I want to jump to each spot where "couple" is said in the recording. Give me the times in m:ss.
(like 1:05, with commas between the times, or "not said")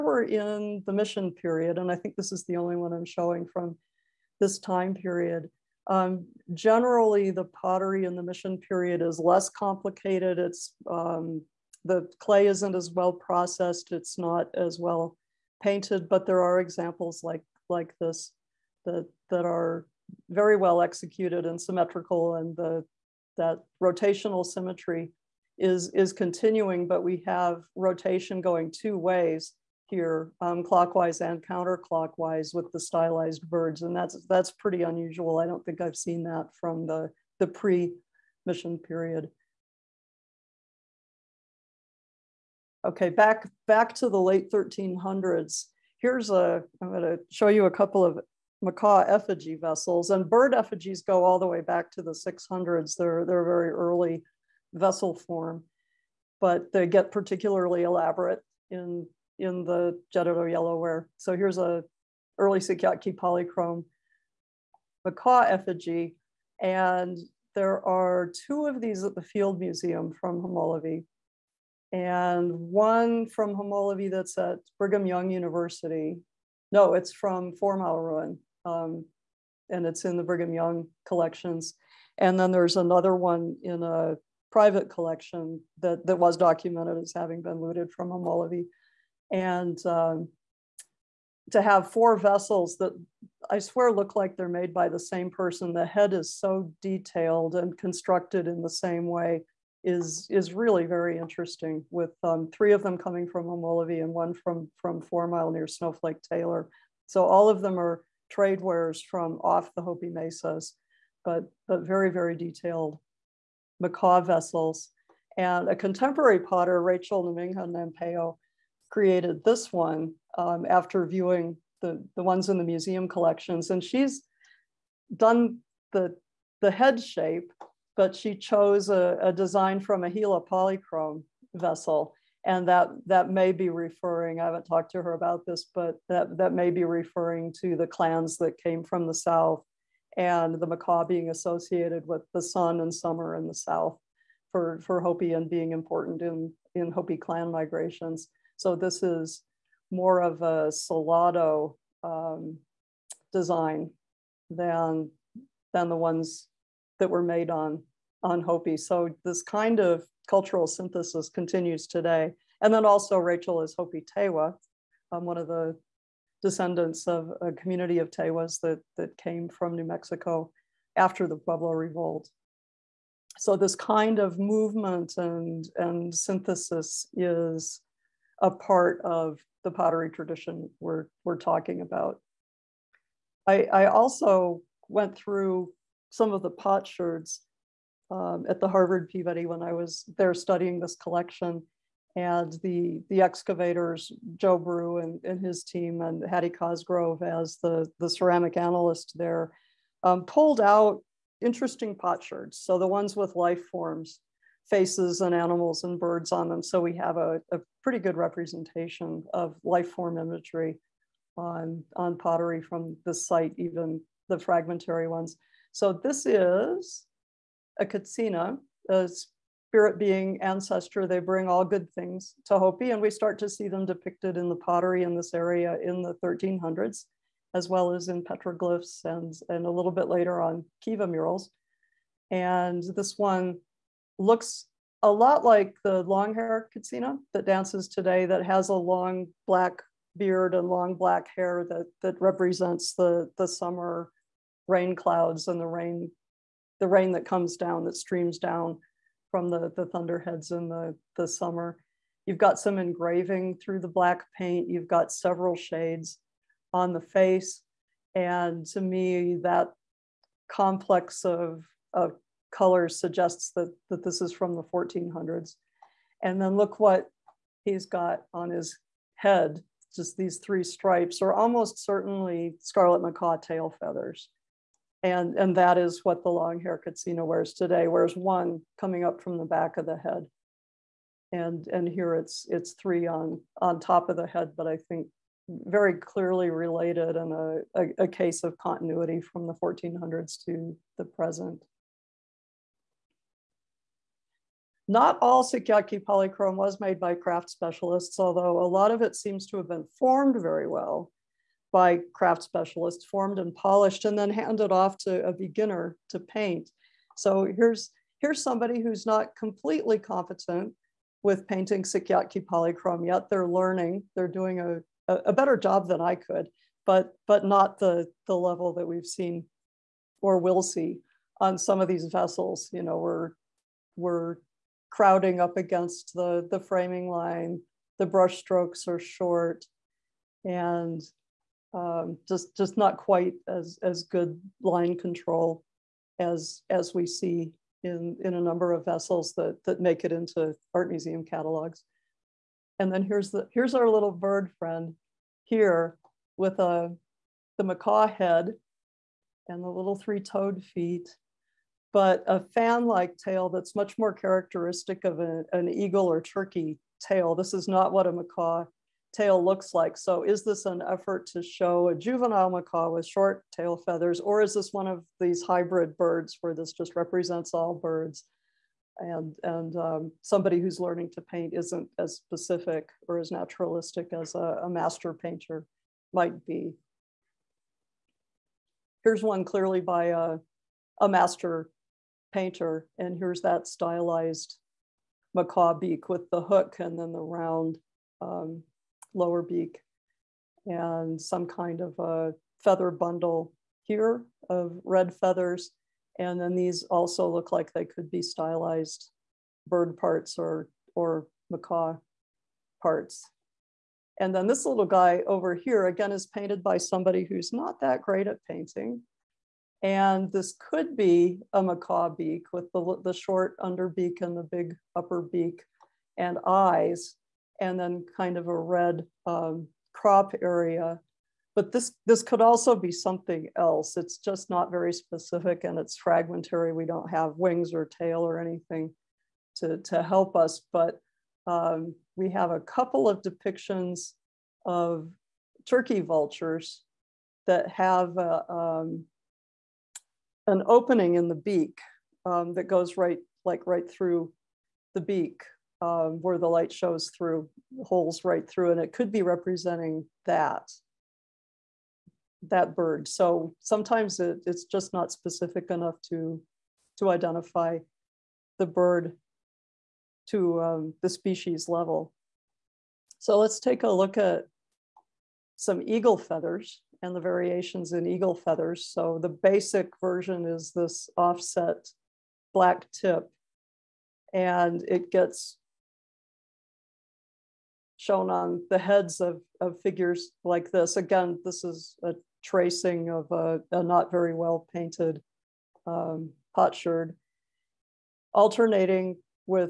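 0:47, 7:12.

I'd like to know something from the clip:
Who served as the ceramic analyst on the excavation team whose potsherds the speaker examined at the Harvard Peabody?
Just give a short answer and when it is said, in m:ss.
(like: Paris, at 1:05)
Hattie Cosgrove, at 3:16.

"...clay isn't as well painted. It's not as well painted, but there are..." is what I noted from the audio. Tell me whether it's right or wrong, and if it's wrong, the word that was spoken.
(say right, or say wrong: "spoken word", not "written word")
wrong: "processed", not "painted".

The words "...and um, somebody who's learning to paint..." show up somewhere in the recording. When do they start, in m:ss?
6:09.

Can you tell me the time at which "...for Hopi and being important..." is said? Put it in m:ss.
2:24.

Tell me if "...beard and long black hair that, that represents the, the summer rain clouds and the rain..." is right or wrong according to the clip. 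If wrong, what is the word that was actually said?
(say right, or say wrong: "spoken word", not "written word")
right.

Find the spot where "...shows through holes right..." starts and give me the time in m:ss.
7:26.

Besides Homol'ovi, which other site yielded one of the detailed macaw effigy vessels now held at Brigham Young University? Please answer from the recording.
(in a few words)
Fourmile Ruin.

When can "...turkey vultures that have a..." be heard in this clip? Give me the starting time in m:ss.
7:15.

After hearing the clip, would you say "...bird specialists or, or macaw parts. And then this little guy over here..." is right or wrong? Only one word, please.
wrong.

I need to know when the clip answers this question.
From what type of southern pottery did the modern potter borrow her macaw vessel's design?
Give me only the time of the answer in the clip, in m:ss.
2:10.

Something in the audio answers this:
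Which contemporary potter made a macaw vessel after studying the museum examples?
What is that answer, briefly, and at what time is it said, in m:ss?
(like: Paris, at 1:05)
Rachel Namingha Nampeyo, at 1:56.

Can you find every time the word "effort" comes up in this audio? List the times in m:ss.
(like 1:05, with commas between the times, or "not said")
6:00.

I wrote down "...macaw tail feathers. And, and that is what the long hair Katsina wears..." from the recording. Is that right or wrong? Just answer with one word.
right.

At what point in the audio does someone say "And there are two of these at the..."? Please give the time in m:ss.
1:06.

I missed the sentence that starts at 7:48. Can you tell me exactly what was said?
So the basic version is this offset black tip and it gets shown on the heads of, of figures like this.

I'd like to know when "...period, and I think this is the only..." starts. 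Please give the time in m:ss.
0:01.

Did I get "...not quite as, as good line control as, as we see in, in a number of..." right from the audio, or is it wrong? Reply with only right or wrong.
right.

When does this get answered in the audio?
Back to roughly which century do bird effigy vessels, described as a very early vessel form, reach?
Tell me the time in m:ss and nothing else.
0:52.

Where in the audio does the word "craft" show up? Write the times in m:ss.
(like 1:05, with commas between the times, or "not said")
4:57, 5:02.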